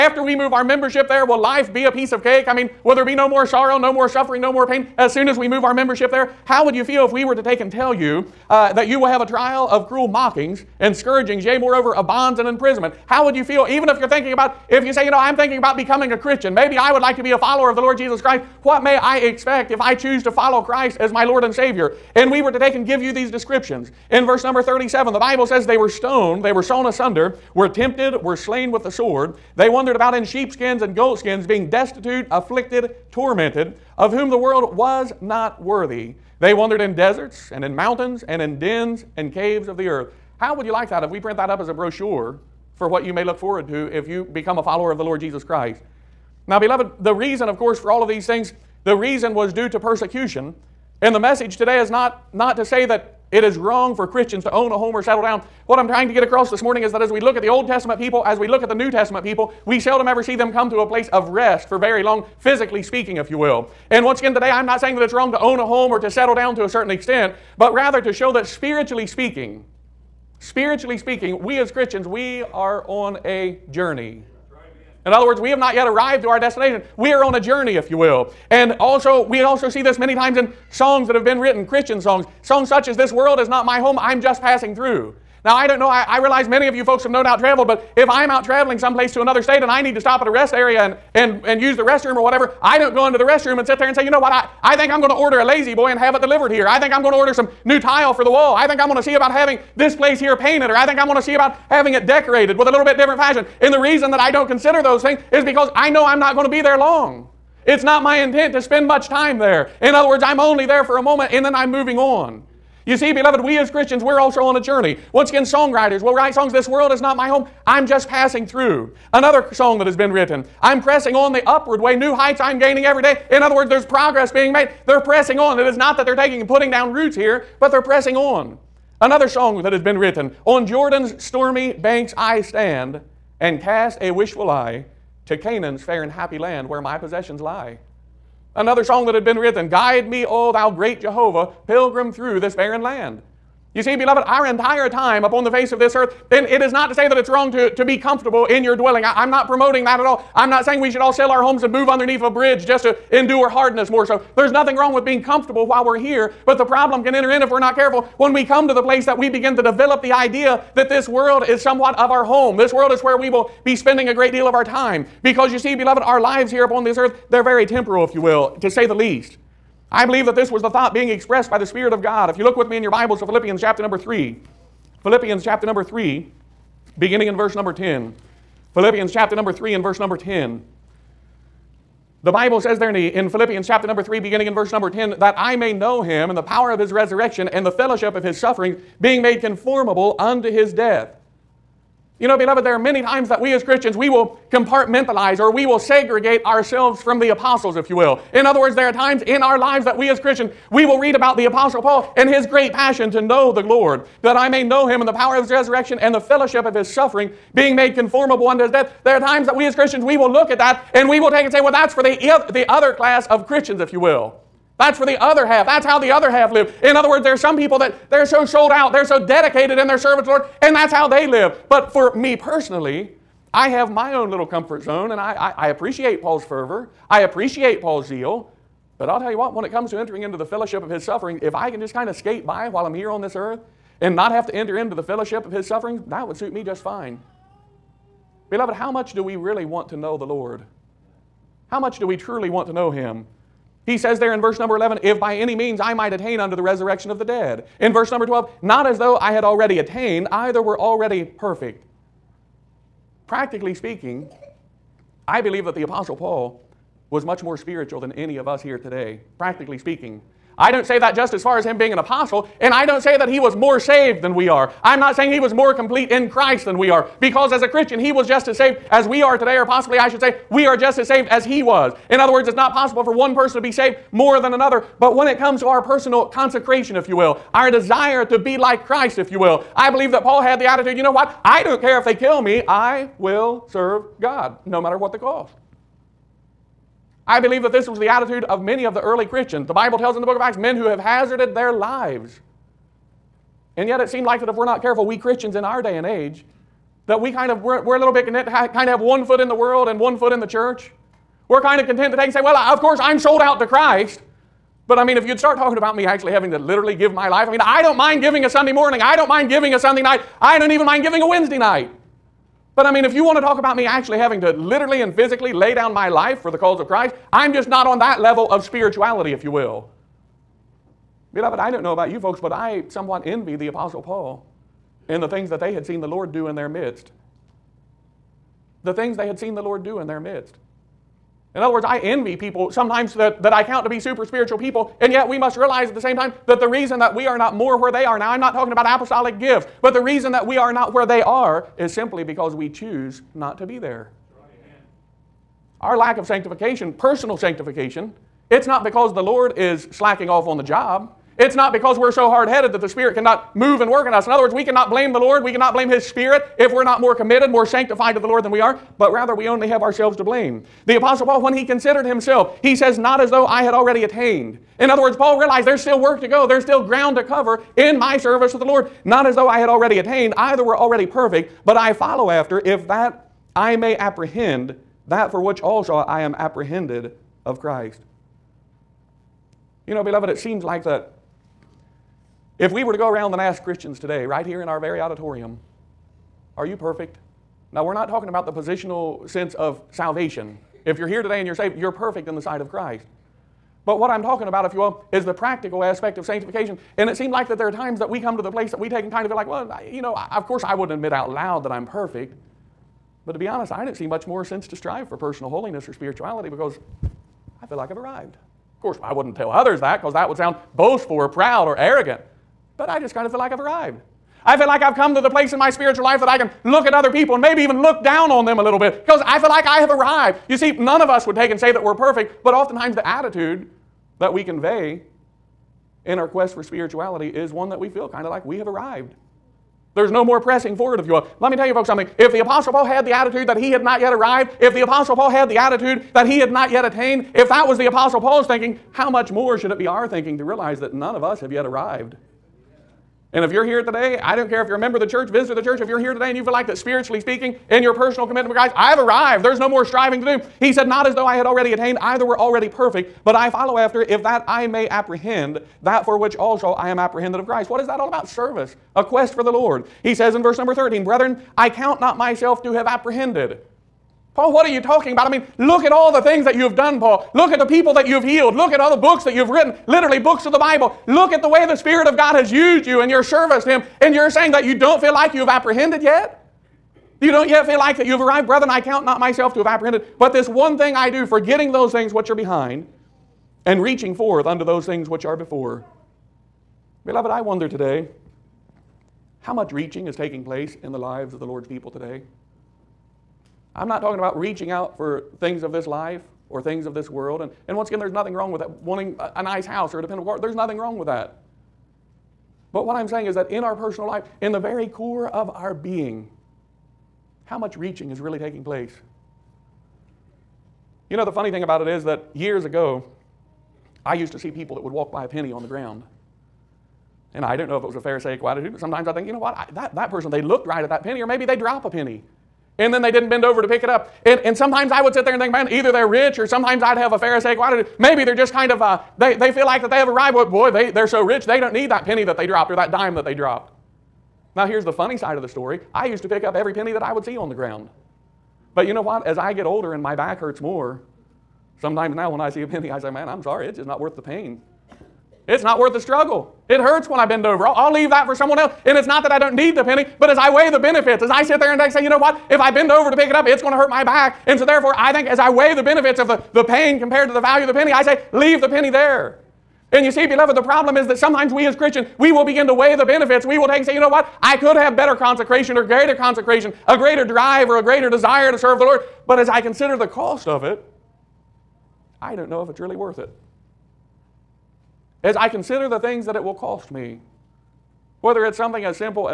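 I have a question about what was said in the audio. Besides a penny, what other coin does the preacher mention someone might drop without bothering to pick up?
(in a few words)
dime.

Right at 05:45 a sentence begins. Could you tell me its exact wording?
Our lack of sanctification, personal sanctification, it's not because the Lord is slacking off on the job.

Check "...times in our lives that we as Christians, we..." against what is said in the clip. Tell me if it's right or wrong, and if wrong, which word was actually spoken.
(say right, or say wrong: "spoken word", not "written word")
right.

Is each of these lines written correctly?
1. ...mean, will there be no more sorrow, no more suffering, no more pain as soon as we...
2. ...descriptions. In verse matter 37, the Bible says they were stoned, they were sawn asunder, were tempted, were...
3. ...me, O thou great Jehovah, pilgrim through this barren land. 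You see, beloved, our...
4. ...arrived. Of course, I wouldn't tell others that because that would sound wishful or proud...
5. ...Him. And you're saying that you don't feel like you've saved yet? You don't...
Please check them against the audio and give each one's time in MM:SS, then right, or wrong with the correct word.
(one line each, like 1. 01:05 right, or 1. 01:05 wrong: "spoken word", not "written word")
1. 00:02 right
2. 00:23 wrong: "number", not "matter"
3. 02:20 right
4. 06:47 wrong: "boastful", not "wishful"
5. 07:53 wrong: "apprehended", not "saved".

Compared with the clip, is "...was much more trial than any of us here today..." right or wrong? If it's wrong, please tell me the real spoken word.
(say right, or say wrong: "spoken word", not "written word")
wrong: "spiritual", not "trial".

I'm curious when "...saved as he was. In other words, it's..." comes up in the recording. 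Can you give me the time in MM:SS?
04:31.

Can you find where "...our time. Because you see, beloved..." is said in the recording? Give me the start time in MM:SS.
02:44.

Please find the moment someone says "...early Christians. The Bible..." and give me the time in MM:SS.
04:49.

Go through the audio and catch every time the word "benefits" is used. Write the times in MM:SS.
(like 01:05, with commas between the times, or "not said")
09:10, 09:15, 09:23.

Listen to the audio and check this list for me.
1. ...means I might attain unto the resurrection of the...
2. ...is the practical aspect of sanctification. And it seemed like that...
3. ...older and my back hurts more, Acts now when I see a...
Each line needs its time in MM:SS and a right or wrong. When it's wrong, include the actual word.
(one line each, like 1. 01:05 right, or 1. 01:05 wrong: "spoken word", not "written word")
1. 04:05 right
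2. 06:35 right
3. 08:59 wrong: "Sometimes", not "Acts".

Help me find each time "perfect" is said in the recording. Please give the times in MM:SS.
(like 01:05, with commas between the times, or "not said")
04:11, 06:11, 06:26, 06:31, 06:41, 07:01, 07:32.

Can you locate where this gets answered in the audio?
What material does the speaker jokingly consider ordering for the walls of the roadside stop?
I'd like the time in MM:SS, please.
01:37.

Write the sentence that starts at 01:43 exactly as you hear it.
And the reason that I don't consider those things is because I know I'm not going to be there long.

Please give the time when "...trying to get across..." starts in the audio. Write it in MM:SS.
00:55.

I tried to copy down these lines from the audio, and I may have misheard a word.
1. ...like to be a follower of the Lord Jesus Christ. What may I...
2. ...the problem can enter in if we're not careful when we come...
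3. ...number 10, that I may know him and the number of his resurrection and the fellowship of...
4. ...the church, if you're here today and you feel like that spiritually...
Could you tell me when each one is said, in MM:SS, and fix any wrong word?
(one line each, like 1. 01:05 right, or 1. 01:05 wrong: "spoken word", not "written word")
1. 00:17 right
2. 02:36 right
3. 03:04 wrong: "power", not "number"
4. 07:25 right.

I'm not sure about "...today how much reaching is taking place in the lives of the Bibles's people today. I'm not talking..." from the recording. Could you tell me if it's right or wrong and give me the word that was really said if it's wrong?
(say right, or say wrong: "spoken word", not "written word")
wrong: "Lord", not "Bibles".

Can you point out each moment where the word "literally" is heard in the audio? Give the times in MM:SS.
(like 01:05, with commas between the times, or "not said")
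05:06, 05:14, 07:49.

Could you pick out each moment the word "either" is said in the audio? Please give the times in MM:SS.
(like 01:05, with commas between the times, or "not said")
04:10, 06:10, 07:31, 08:45.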